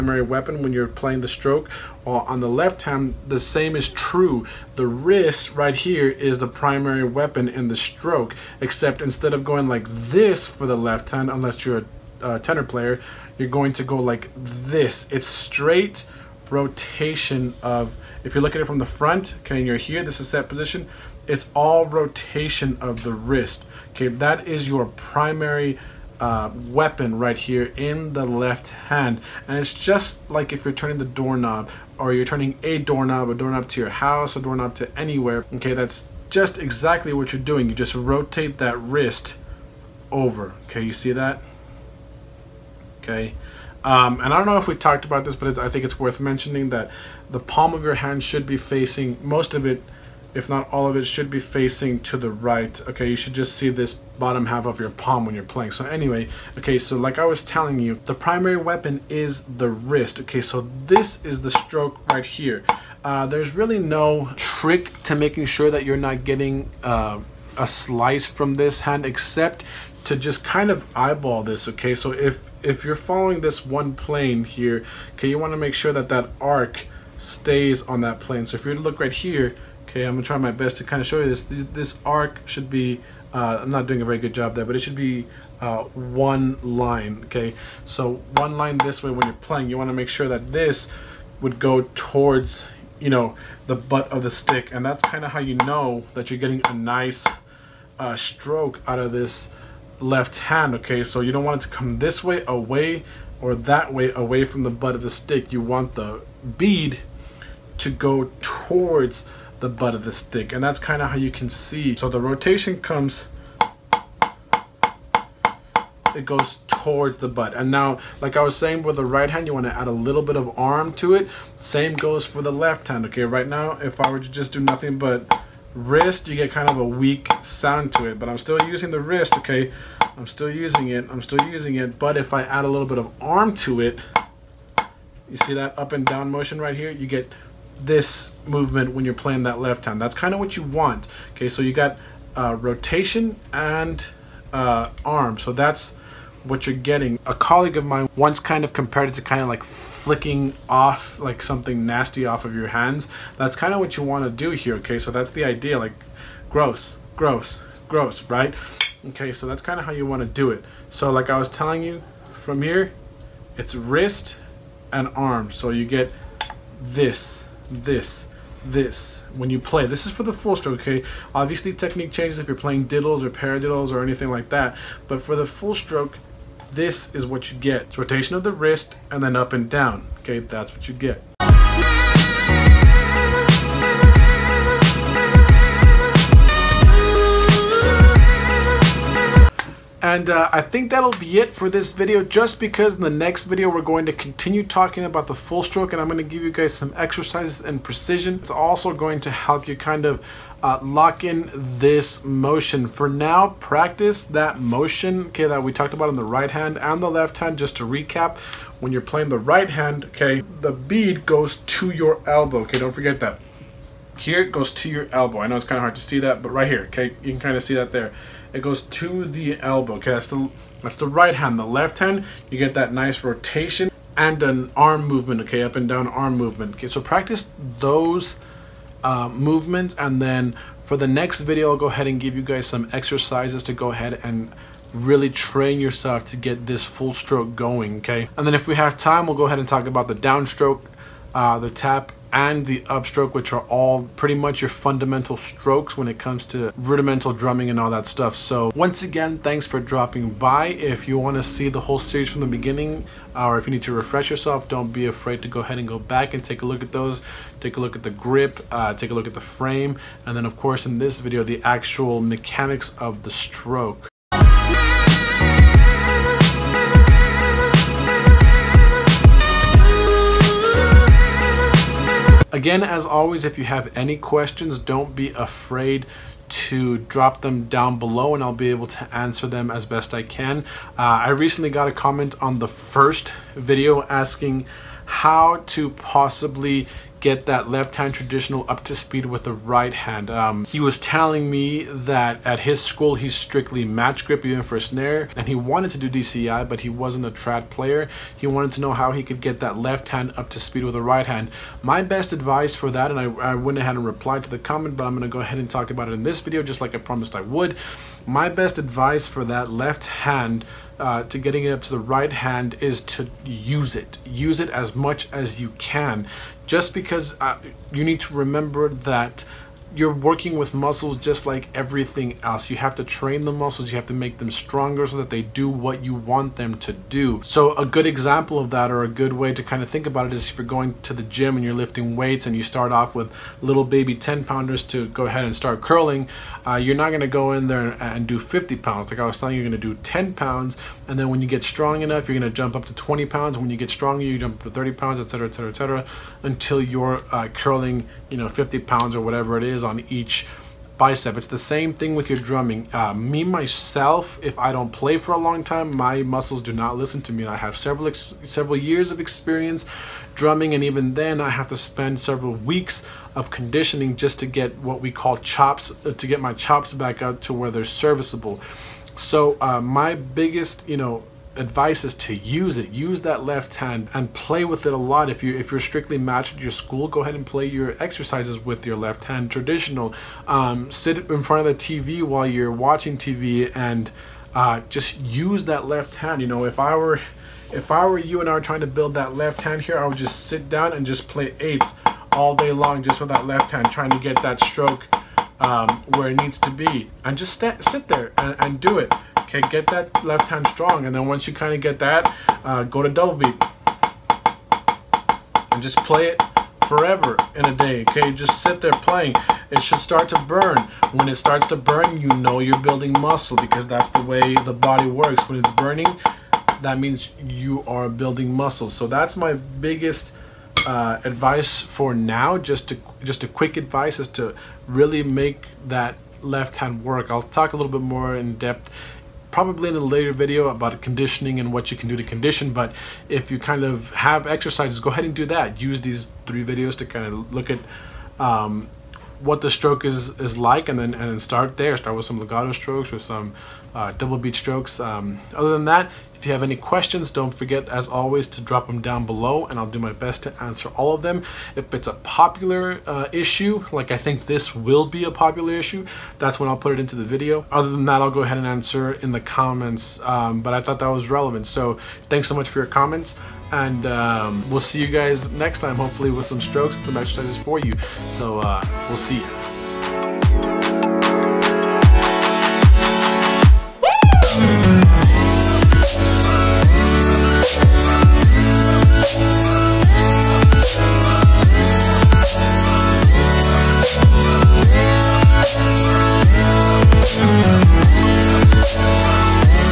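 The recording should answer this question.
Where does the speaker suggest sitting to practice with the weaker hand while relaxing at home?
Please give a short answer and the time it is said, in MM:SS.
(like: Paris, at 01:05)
In front of the TV, at 06:21.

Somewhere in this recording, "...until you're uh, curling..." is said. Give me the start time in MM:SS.
05:46.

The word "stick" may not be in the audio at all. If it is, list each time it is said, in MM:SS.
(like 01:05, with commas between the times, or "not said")
01:34, 01:45, 01:50.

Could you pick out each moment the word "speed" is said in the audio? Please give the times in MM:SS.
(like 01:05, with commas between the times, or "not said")
04:48, 05:00.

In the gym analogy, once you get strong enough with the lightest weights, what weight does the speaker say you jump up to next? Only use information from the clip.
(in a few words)
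20 pounds.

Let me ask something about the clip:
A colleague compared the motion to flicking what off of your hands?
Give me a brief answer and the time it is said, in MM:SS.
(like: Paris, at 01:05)
Something nasty, at 02:31.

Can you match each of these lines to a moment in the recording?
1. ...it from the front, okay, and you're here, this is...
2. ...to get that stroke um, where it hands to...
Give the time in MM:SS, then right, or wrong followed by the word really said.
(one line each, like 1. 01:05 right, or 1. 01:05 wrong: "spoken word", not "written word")
1. 00:18 right
2. 06:34 wrong: "needs", not "hands".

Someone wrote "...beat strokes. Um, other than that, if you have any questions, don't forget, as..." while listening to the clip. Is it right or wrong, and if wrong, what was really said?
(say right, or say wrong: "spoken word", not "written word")
right.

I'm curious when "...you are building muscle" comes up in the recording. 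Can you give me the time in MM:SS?
06:57.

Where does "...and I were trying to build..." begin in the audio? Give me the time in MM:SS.
06:28.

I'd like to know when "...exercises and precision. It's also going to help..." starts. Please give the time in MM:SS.
03:16.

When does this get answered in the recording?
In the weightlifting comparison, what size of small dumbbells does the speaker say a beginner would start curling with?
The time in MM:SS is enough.
05:34.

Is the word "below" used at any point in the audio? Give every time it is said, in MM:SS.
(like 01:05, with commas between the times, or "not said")
04:37, 07:29.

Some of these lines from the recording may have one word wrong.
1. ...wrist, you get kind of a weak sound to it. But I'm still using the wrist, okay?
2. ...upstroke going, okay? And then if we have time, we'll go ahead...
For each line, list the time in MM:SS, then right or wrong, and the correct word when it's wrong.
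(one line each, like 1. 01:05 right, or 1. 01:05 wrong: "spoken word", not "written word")
1. 02:05 right
2. 03:57 wrong: "stroke", not "upstroke".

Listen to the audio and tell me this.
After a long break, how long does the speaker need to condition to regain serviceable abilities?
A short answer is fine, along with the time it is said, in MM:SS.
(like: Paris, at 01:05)
Several weeks, at 06:02.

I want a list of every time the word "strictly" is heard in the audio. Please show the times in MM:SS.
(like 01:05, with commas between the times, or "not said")
04:53, 06:15.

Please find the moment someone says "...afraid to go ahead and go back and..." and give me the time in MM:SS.
04:15.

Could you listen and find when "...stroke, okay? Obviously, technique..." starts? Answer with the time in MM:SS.
02:50.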